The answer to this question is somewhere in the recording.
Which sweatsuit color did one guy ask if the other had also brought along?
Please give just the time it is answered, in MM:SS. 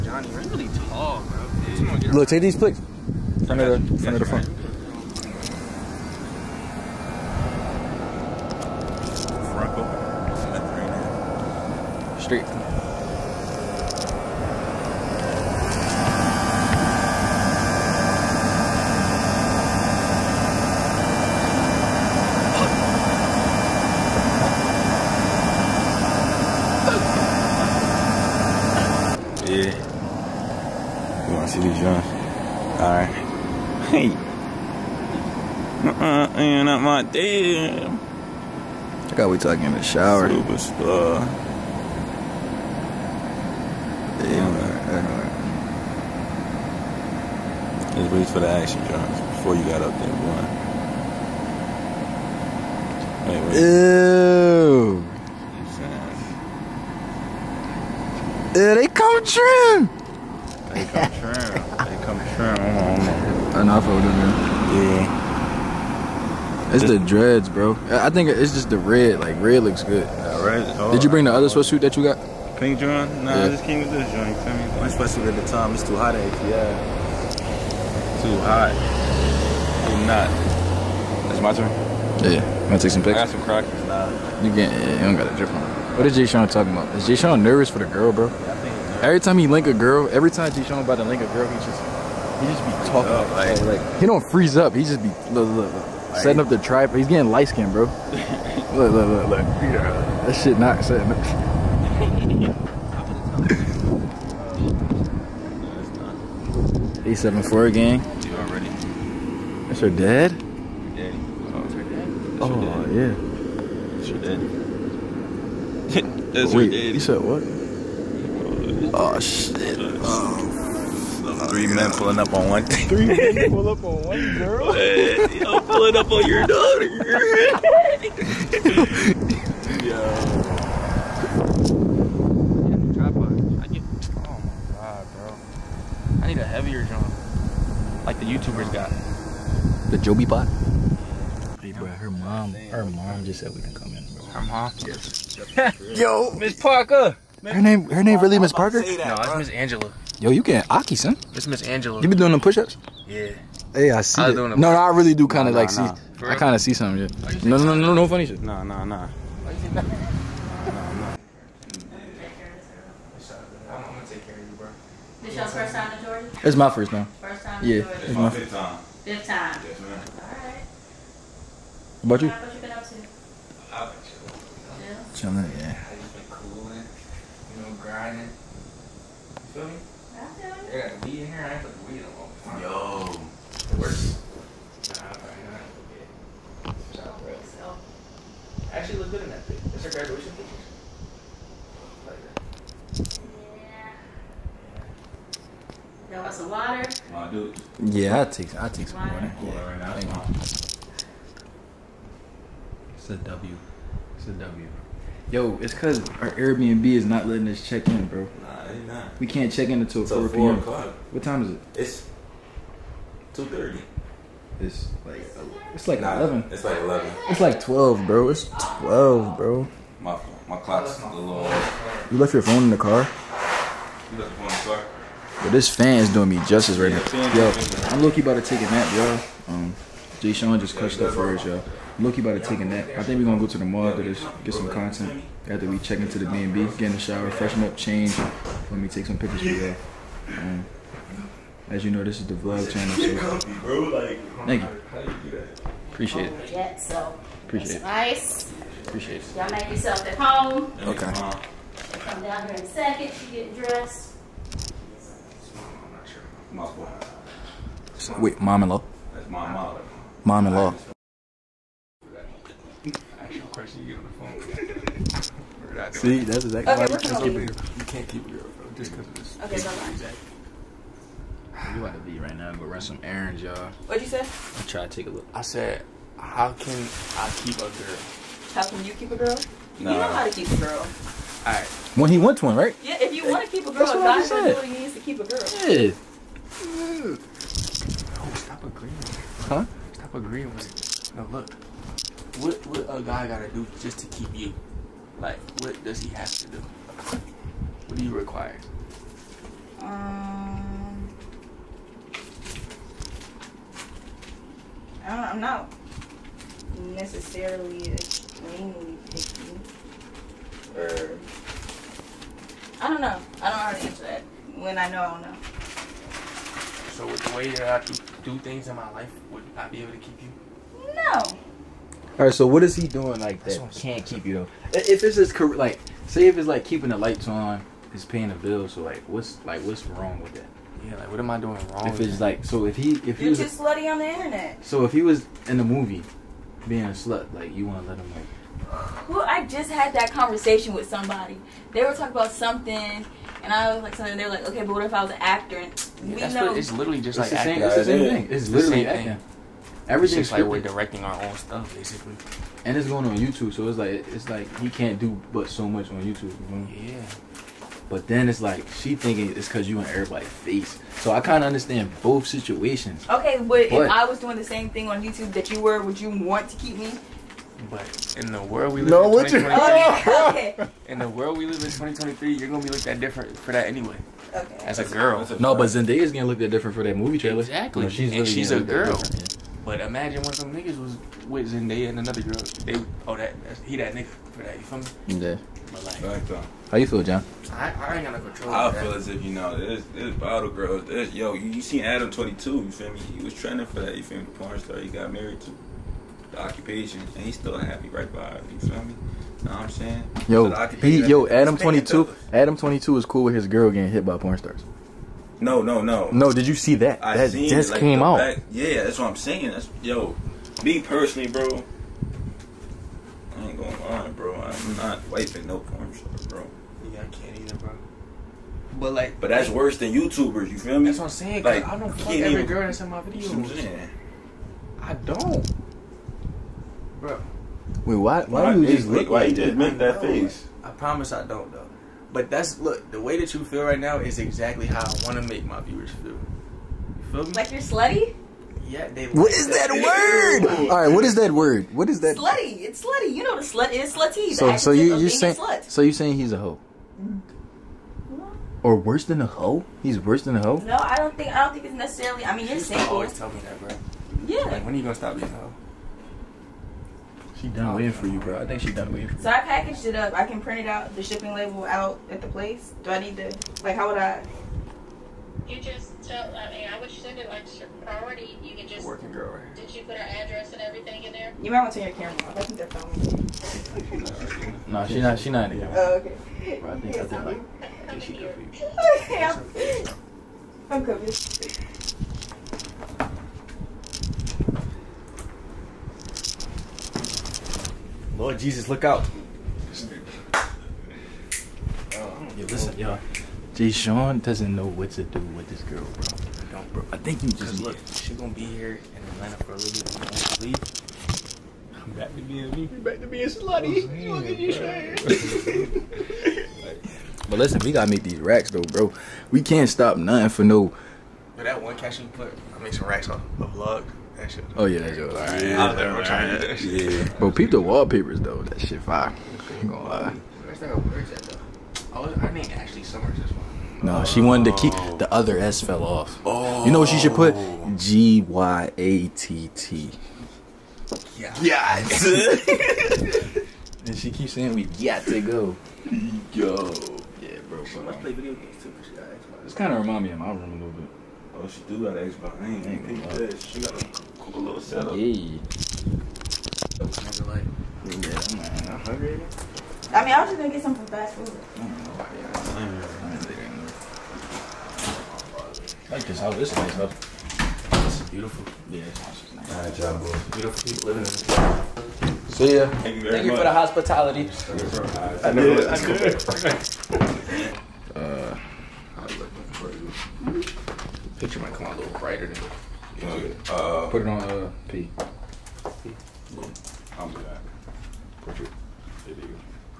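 01:12.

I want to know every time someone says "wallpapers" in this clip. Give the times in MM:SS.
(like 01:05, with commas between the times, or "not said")
08:37.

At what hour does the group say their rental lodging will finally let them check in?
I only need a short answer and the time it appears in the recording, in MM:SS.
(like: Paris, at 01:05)
4 p.m., at 03:30.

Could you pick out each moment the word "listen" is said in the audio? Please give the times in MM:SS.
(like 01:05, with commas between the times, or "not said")
08:12, 08:27.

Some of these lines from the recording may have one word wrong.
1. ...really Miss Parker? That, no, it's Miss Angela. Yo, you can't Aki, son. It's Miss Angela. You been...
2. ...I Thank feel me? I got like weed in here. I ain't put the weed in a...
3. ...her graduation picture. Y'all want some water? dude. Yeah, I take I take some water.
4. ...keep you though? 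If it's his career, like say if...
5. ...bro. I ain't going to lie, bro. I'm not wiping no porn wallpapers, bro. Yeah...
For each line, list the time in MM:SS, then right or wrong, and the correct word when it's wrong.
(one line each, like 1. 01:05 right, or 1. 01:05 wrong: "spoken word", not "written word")
1. 02:28 right
2. 02:57 wrong: "You", not "Thank"
3. 03:09 right
4. 05:24 right
5. 06:51 wrong: "stars", not "wallpapers".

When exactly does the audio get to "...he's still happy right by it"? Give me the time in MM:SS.
06:37.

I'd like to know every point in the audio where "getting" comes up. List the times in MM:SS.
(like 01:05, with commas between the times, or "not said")
01:37, 06:43.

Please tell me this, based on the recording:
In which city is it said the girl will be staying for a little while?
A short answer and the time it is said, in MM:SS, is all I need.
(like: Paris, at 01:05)
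Atlanta, at 08:19.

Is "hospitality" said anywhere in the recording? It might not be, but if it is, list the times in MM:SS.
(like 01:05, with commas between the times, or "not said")
09:23.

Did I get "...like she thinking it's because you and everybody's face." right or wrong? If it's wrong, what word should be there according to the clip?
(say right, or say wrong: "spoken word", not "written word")
right.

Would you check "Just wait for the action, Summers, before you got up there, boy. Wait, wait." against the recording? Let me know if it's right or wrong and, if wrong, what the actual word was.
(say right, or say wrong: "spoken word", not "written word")
wrong: "John", not "Summers".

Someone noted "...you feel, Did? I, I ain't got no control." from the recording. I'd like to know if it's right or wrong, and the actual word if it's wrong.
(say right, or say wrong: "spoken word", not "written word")
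wrong: "John", not "Did".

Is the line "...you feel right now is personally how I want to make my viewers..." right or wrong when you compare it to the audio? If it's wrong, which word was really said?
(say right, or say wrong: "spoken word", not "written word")
wrong: "exactly", not "personally".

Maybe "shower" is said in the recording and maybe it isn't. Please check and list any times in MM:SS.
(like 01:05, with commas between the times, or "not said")
00:39, 03:56.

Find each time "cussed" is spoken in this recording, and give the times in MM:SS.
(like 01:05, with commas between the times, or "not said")
03:50.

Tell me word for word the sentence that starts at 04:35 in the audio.
I said, how can I keep a girl?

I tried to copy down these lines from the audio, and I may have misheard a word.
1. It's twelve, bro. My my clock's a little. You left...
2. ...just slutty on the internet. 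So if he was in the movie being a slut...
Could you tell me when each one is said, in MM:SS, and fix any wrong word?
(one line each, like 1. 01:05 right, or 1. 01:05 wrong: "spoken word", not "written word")
1. 03:38 right
2. 05:33 right.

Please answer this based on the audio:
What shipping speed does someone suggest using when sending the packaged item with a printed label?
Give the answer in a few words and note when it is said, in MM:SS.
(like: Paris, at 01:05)
Priority, at 07:47.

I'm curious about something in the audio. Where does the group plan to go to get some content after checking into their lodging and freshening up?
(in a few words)
The mall.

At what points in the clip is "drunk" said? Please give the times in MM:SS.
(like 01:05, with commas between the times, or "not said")
00:31.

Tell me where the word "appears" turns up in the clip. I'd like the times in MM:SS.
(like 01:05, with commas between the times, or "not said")
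not said.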